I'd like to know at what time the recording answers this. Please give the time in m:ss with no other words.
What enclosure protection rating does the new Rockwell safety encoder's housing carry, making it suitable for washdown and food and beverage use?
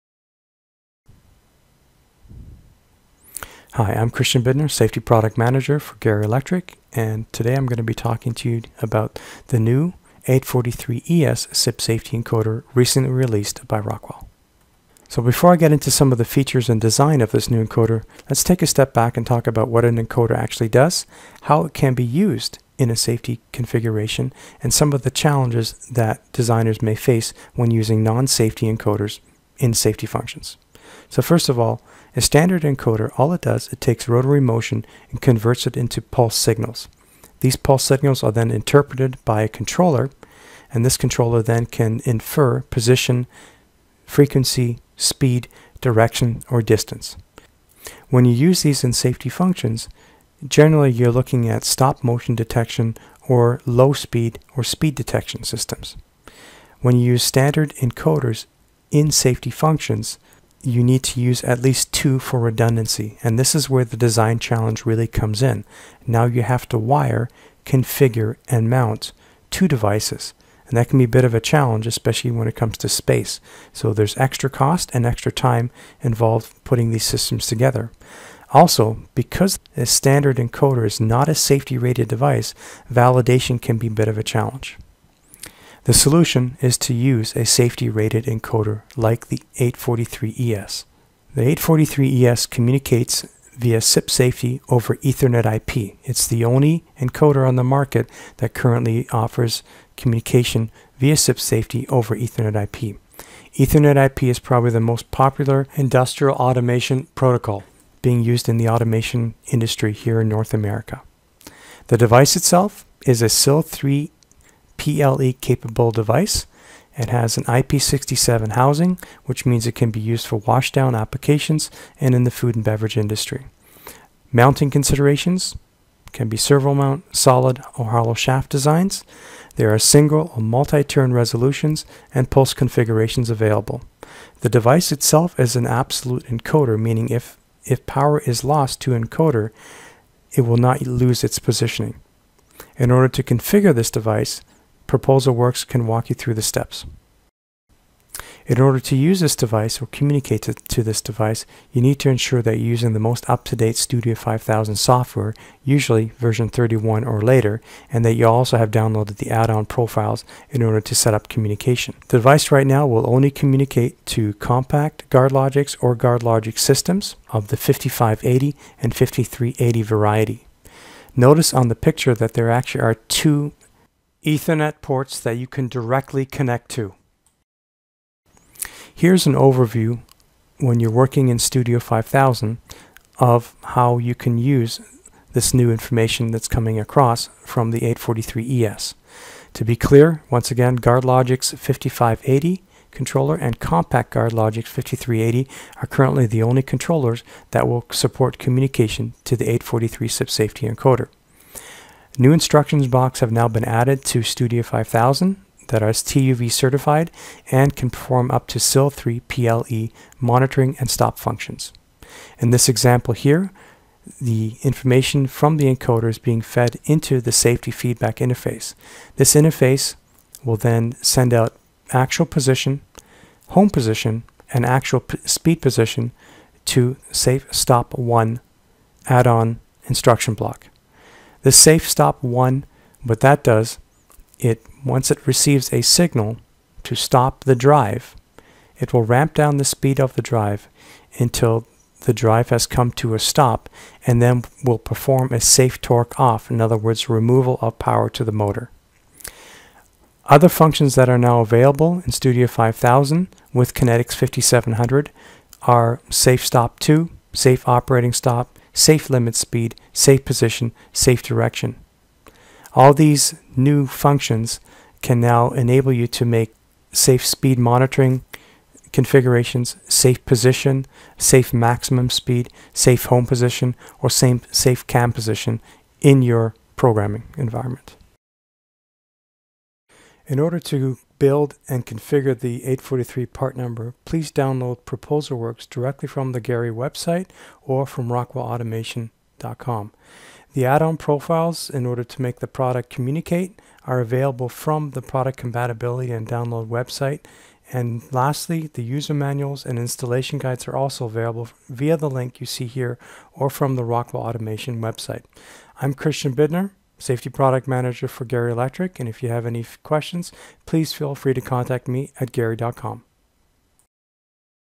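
1:57.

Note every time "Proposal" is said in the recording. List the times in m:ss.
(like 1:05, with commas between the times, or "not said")
2:24, 4:44.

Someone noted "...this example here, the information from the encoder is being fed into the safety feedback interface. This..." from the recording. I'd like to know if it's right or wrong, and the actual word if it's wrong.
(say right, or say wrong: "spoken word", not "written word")
right.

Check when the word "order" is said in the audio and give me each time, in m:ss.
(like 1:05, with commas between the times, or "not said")
2:22, 2:28, 2:40, 4:40, 4:51.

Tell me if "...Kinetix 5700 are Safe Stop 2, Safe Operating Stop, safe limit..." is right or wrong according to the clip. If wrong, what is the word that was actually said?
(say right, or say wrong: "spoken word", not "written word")
right.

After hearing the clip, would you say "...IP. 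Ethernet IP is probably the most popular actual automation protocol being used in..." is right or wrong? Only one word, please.
wrong.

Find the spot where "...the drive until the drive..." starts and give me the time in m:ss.
4:00.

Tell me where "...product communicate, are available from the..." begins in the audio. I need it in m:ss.
4:52.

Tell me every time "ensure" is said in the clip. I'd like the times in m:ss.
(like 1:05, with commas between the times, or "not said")
2:32.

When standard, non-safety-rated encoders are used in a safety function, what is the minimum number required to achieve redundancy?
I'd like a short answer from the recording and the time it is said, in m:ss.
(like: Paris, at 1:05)
2, at 1:01.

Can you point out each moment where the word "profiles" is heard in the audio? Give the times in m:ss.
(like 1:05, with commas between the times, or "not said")
2:39, 4:50.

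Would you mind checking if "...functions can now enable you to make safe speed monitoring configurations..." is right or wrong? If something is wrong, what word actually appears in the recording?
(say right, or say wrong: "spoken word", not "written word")
right.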